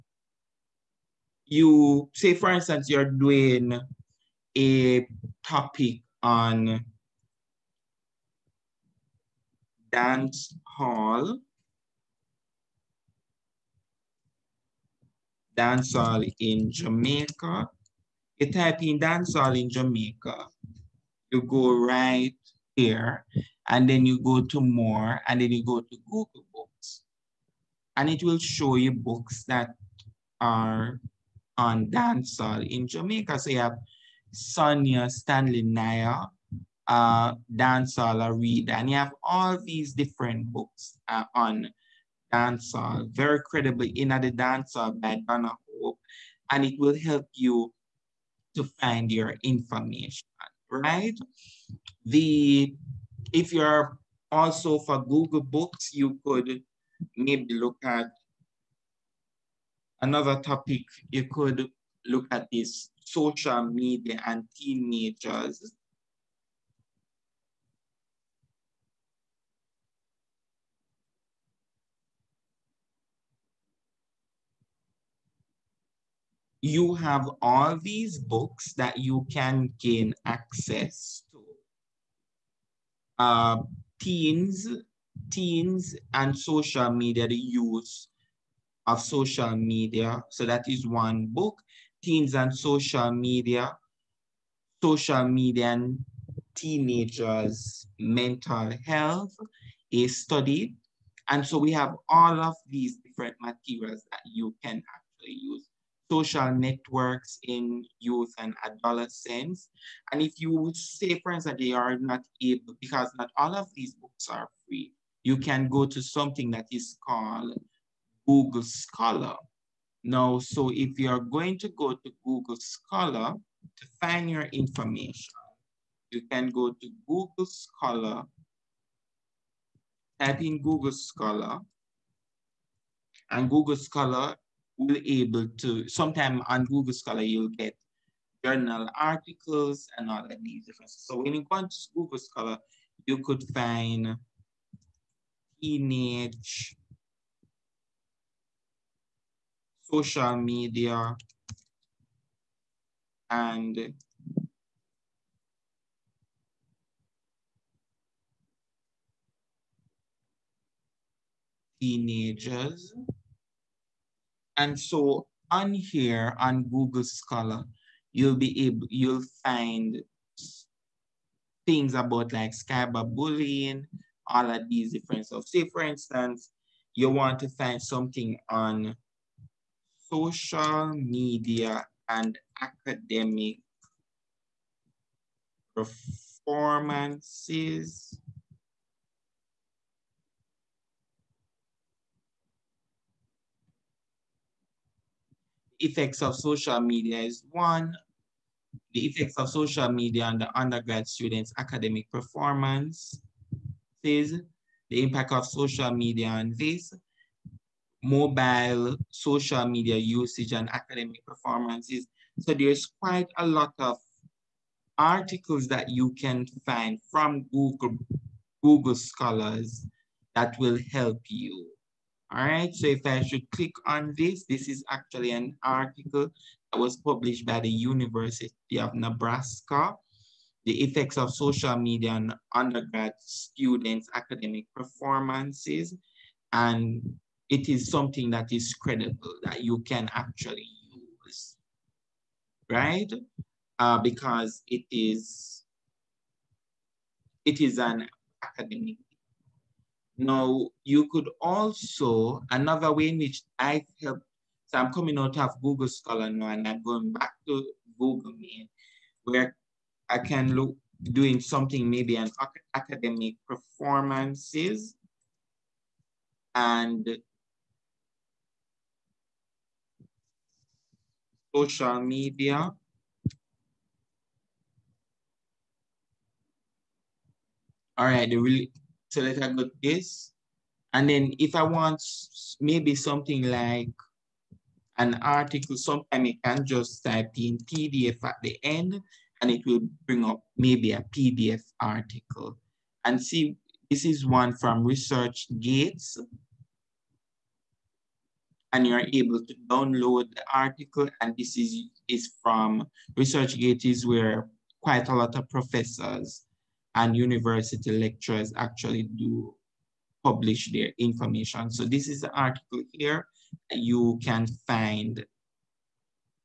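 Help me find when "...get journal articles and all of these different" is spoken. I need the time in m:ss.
2:17.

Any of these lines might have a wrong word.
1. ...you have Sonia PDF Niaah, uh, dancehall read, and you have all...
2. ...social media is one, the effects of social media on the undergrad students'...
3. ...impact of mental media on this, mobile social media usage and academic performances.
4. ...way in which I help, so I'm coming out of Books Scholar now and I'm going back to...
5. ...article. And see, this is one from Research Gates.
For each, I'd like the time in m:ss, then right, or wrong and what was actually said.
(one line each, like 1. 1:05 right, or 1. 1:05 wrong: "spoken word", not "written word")
1. 0:33 wrong: "Stanley", not "PDF"
2. 3:16 right
3. 3:25 wrong: "social", not "mental"
4. 4:12 wrong: "Google", not "Books"
5. 4:51 right.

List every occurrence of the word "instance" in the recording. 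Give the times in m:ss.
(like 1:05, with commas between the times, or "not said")
0:02, 1:51, 2:55.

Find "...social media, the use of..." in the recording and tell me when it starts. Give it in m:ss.
1:26.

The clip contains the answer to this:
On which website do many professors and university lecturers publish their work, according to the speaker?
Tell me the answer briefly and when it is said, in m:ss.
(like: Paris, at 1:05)
ResearchGate, at 5:03.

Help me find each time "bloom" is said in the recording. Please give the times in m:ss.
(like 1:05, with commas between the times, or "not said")
not said.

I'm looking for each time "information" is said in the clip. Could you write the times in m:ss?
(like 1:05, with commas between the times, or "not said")
0:49, 2:04, 5:10.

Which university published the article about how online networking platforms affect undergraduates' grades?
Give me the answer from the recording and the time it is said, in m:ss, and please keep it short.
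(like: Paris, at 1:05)
University of Nebraska, at 3:47.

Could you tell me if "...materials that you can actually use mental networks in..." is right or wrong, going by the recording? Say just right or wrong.
wrong.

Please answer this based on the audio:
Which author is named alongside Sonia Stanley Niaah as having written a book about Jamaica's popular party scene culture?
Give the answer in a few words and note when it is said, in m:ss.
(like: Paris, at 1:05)
Donna Hope, at 0:45.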